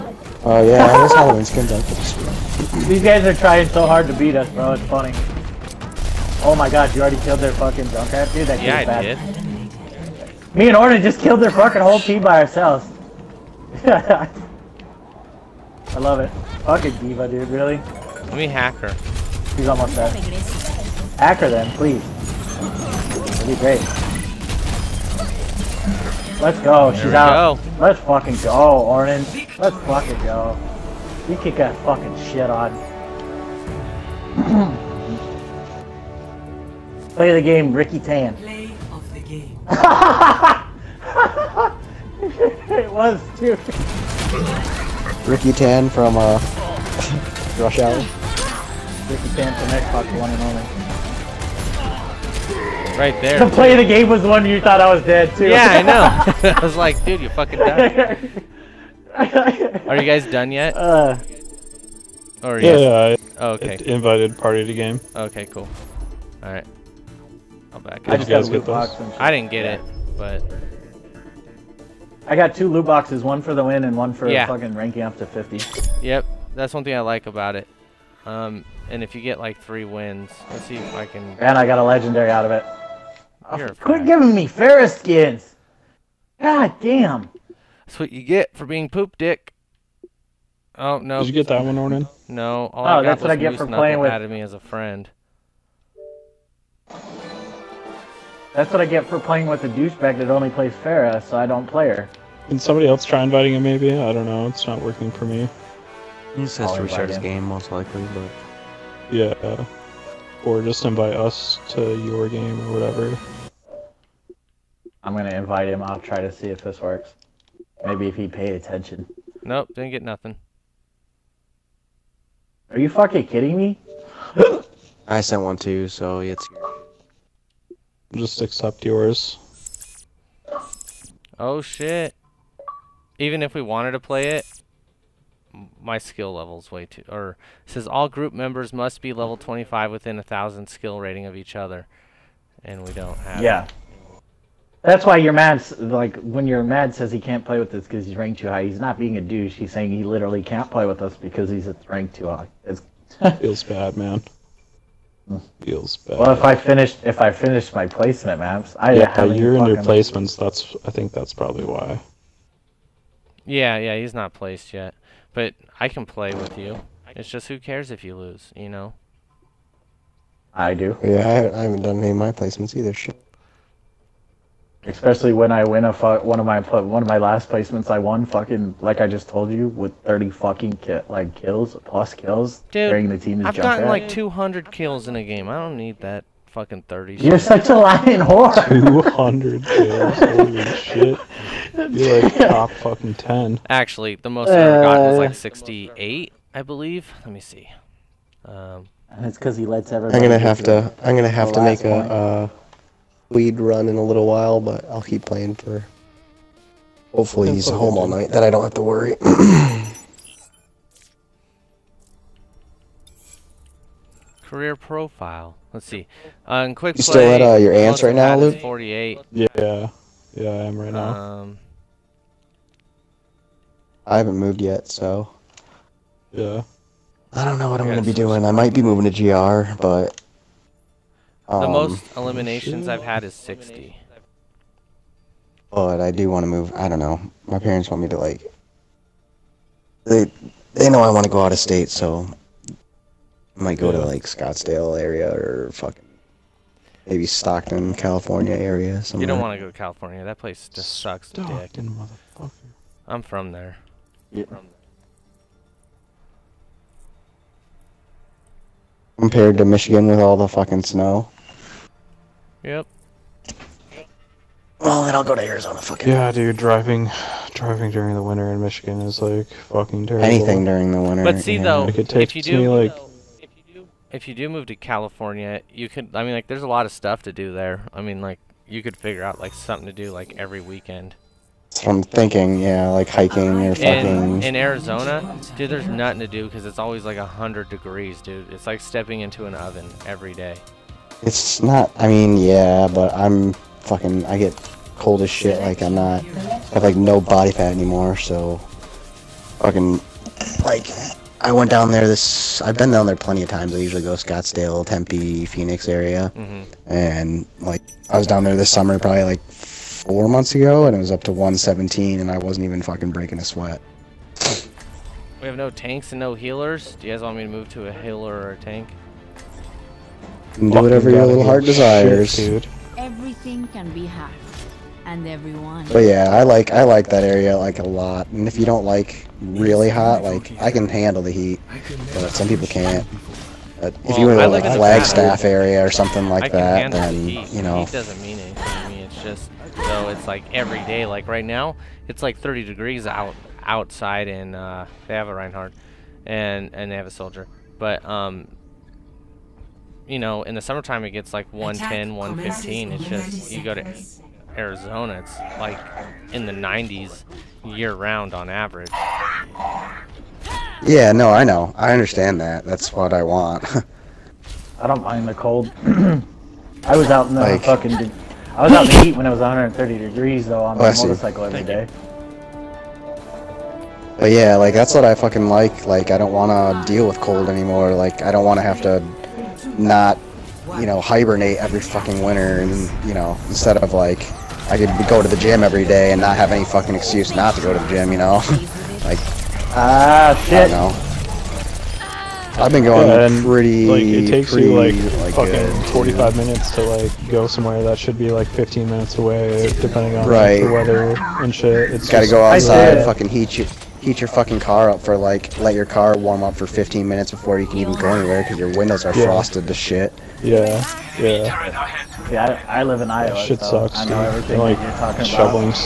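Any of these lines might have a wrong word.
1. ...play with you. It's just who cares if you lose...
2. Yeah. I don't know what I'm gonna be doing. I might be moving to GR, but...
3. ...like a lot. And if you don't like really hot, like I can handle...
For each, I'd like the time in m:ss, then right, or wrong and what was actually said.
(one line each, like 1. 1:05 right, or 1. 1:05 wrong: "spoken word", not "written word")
1. 2:46 right
2. 3:46 right
3. 5:27 right.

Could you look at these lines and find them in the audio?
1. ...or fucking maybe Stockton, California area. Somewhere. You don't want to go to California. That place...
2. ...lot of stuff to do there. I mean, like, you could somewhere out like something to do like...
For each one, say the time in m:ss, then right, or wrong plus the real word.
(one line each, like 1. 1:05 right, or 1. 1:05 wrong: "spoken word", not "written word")
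1. 4:05 right
2. 4:36 wrong: "figure", not "somewhere".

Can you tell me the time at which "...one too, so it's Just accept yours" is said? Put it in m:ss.
2:05.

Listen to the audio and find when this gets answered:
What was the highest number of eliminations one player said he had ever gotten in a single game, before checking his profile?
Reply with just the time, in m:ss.
3:15.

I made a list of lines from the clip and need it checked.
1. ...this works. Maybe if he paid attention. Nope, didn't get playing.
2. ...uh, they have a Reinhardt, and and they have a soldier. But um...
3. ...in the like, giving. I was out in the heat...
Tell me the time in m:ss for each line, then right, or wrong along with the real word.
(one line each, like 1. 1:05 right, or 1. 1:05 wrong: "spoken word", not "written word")
1. 1:56 wrong: "nothing", not "playing"
2. 5:44 right
3. 6:07 wrong: "fucking", not "giving".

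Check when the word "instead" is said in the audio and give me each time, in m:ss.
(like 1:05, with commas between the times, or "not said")
6:23.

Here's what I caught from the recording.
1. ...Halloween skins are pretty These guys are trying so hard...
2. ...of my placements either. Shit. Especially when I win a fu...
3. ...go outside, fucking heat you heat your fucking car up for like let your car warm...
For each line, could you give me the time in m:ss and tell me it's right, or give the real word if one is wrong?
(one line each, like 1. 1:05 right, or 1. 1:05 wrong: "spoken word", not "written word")
1. 0:01 right
2. 2:52 right
3. 6:42 right.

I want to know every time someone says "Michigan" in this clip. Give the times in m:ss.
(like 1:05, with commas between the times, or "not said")
4:19, 4:28.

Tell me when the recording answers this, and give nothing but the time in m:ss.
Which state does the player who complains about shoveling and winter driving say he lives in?
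6:53.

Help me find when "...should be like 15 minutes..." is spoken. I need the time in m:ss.
6:37.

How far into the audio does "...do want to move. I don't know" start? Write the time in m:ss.
3:56.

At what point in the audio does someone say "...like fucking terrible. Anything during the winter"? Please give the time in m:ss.
4:29.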